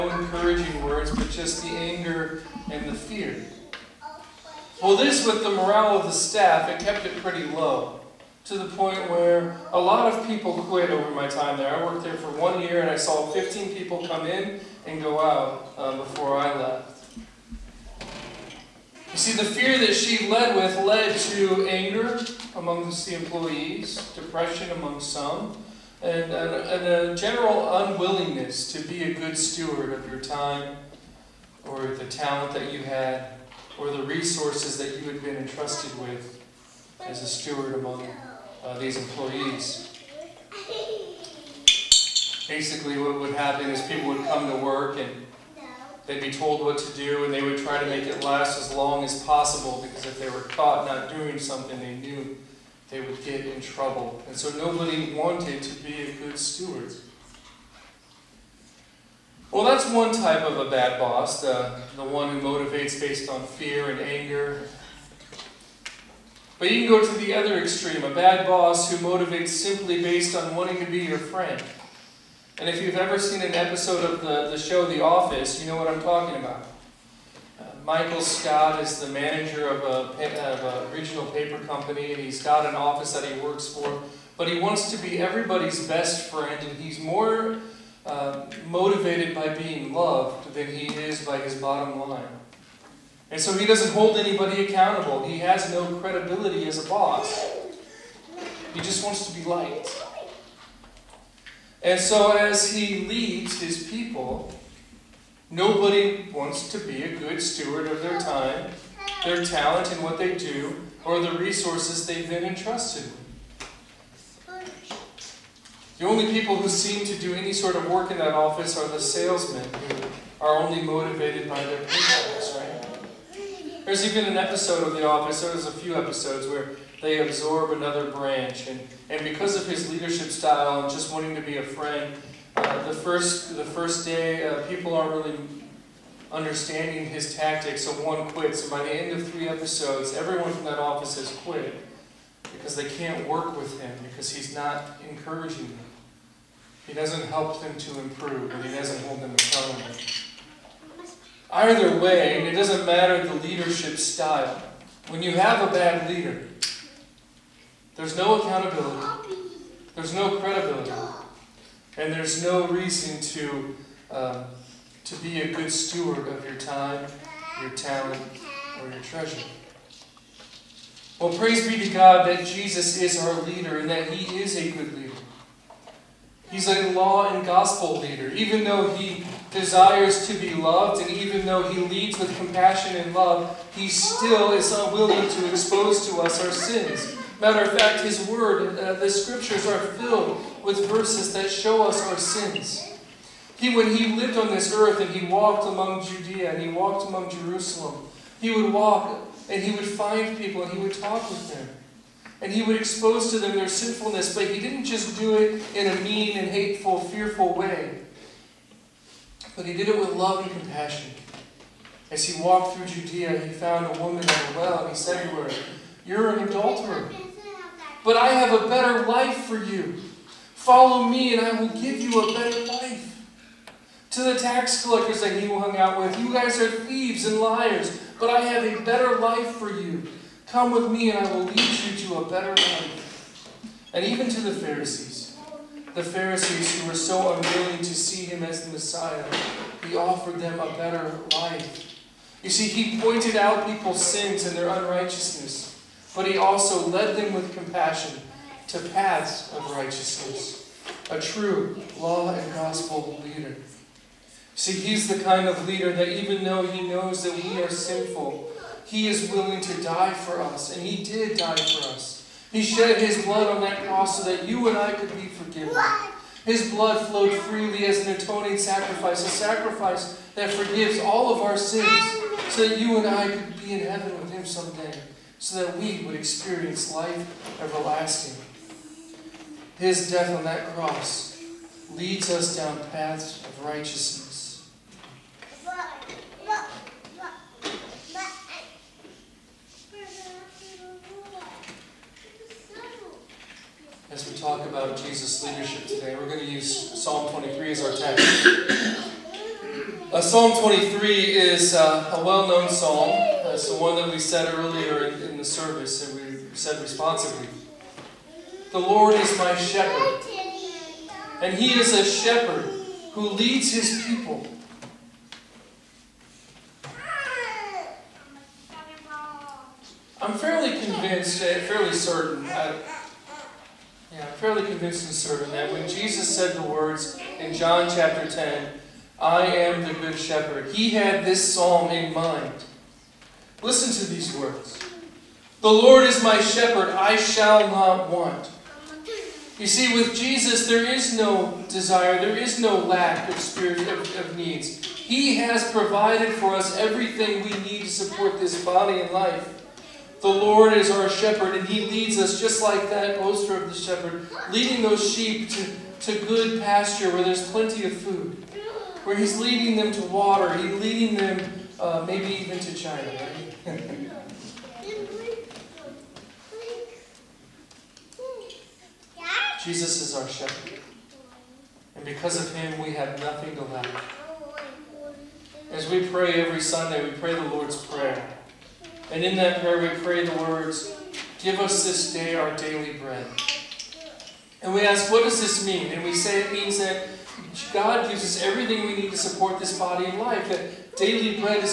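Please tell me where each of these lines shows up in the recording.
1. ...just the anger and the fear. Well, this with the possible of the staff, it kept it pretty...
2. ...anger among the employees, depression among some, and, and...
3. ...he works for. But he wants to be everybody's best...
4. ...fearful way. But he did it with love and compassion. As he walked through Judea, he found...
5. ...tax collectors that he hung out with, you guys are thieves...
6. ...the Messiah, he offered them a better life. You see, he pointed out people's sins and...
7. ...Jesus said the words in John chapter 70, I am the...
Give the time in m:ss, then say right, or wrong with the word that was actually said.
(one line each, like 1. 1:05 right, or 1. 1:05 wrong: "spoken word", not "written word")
1. 0:01 wrong: "morale", not "possible"
2. 0:21 right
3. 1:23 right
4. 3:26 right
5. 3:44 right
6. 3:58 right
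7. 5:25 wrong: "10", not "70".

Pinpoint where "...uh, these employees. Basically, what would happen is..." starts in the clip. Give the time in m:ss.
0:38.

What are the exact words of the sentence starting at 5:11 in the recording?
And he is a shepherd who leads his people.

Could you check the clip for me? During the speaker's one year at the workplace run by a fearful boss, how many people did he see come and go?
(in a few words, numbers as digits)
15.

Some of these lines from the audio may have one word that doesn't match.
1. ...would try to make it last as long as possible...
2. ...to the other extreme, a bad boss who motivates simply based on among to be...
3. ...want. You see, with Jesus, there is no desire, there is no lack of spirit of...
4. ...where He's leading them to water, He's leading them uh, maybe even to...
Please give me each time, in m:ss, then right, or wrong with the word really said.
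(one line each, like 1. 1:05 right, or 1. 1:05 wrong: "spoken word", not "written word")
1. 0:47 right
2. 1:07 wrong: "wanting", not "among"
3. 5:38 right
4. 5:59 right.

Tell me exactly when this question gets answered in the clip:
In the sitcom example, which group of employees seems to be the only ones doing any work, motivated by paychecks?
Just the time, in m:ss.
1:58.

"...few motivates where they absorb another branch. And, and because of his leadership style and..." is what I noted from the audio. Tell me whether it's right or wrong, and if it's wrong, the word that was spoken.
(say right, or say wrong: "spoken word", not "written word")
wrong: "episodes", not "motivates".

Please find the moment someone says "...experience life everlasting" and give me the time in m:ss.
4:36.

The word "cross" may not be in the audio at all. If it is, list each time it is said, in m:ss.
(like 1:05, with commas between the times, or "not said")
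4:23, 4:40.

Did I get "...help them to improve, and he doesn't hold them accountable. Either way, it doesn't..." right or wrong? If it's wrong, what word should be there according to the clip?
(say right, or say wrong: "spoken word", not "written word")
right.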